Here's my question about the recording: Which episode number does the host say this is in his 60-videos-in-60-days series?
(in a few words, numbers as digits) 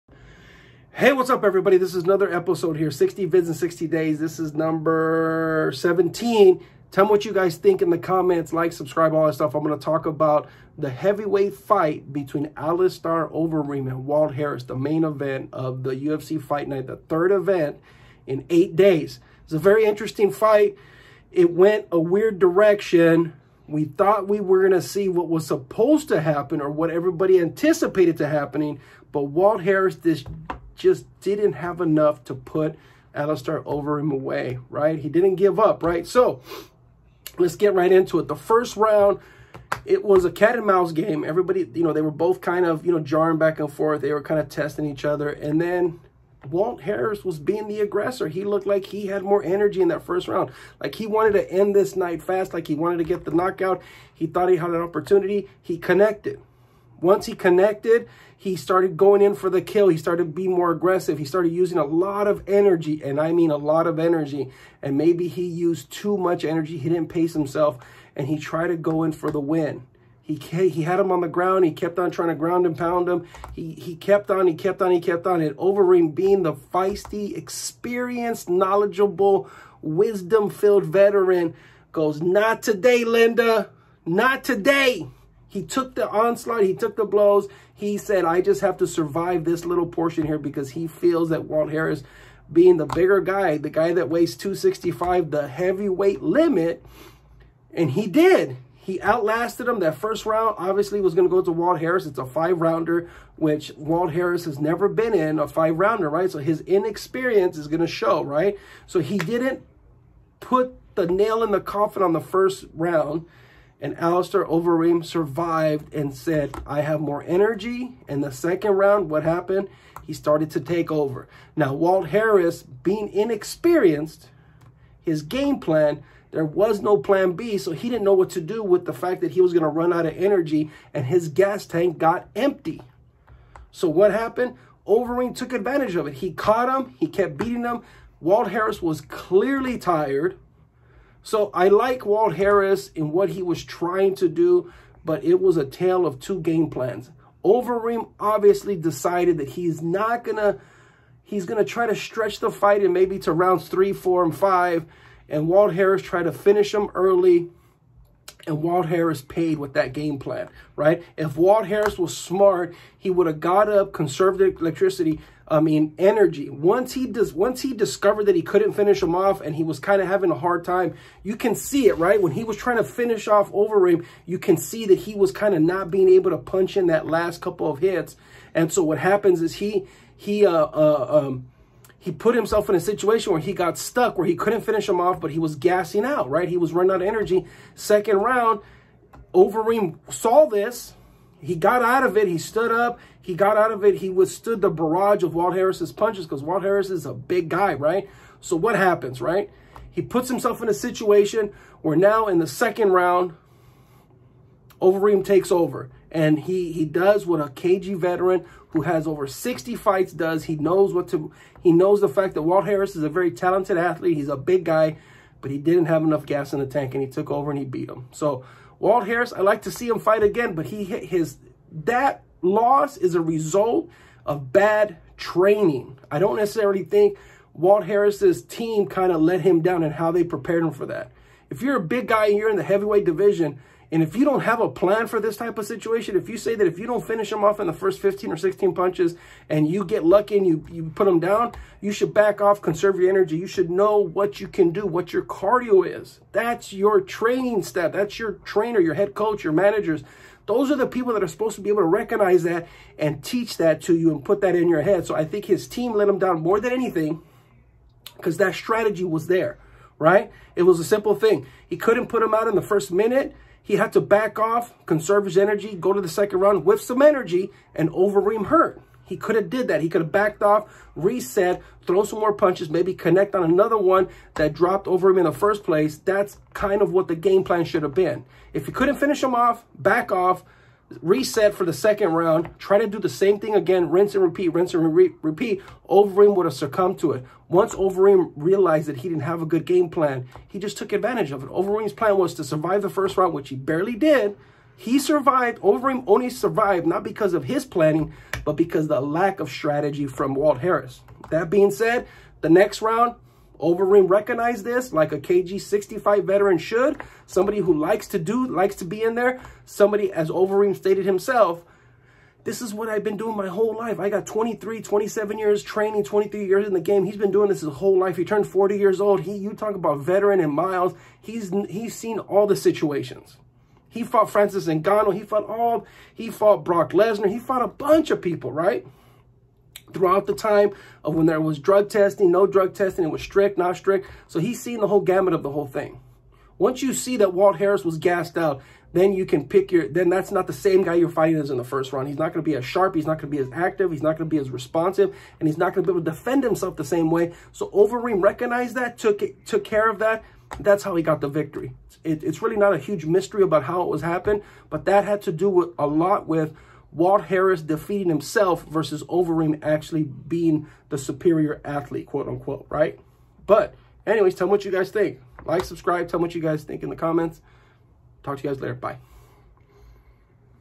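17.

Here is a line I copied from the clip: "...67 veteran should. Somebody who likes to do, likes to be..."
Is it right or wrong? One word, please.
wrong.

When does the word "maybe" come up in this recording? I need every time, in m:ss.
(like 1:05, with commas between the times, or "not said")
1:04, 2:32, 4:32.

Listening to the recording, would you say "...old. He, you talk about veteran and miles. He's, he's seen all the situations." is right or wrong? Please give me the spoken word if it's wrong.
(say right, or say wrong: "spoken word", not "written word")
right.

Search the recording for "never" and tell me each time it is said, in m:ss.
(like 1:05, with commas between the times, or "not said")
1:44.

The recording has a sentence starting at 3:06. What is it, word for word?
He was running out of energy.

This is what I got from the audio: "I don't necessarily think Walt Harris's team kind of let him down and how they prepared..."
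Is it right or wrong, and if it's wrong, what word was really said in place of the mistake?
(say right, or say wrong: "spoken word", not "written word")
right.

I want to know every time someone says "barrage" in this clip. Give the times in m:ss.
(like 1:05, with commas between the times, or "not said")
3:14.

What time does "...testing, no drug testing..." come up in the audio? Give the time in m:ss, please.
5:31.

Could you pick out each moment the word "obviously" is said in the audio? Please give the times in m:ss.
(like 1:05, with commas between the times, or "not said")
1:40, 2:28.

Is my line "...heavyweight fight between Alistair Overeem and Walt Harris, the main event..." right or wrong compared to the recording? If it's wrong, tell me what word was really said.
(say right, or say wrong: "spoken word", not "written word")
right.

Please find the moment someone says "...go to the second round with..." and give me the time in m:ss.
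4:25.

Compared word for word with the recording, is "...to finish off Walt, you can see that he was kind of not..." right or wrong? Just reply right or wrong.
wrong.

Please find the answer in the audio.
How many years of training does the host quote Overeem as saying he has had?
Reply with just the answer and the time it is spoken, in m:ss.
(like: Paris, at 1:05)
27, at 5:14.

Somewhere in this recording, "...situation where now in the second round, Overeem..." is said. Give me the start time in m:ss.
3:20.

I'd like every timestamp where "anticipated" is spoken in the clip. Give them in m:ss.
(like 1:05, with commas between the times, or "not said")
0:27.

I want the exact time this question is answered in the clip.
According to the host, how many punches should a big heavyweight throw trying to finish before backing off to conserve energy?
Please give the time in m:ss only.
3:57.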